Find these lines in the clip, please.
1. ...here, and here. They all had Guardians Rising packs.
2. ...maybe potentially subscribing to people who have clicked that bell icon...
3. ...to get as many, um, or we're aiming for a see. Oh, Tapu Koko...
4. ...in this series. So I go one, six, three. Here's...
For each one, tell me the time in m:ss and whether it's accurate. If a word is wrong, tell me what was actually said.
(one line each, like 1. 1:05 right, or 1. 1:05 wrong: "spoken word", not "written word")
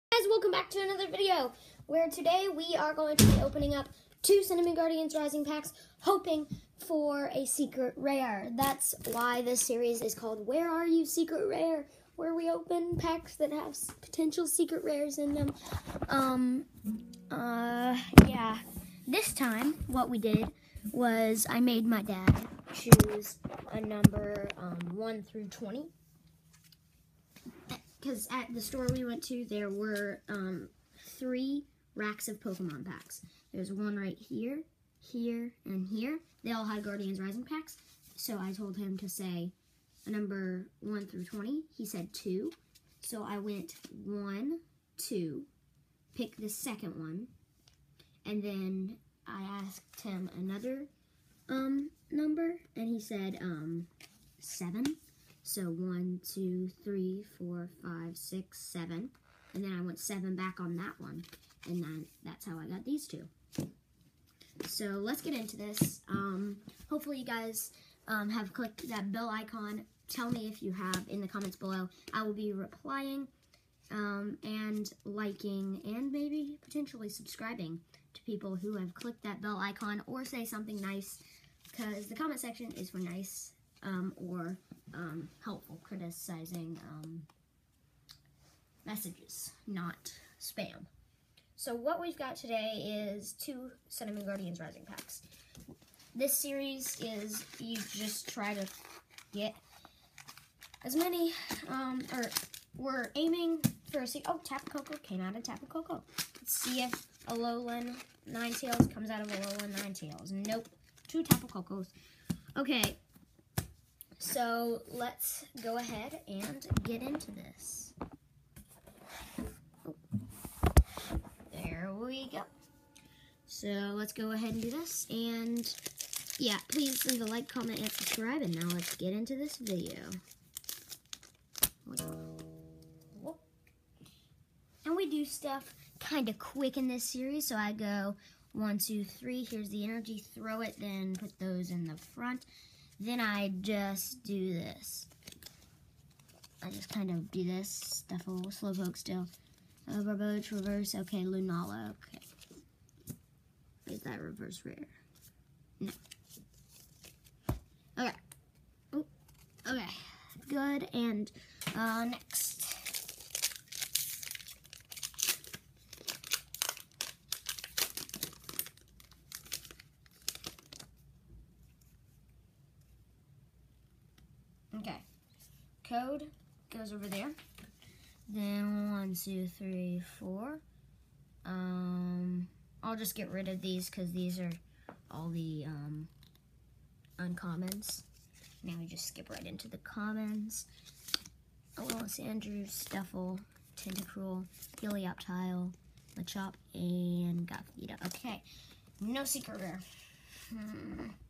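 1. 0:34 right
2. 1:16 right
3. 1:38 right
4. 2:16 wrong: "two", not "six".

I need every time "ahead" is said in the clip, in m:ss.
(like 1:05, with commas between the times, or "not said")
1:55, 2:04.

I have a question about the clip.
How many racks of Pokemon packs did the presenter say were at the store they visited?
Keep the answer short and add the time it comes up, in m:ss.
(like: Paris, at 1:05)
3, at 0:31.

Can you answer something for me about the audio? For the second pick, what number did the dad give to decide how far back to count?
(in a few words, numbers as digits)
7.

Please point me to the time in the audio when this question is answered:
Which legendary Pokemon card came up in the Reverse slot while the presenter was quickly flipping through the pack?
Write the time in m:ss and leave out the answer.
2:31.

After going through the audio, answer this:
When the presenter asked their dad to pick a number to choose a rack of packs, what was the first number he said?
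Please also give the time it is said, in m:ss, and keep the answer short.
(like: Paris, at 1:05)
2, at 0:41.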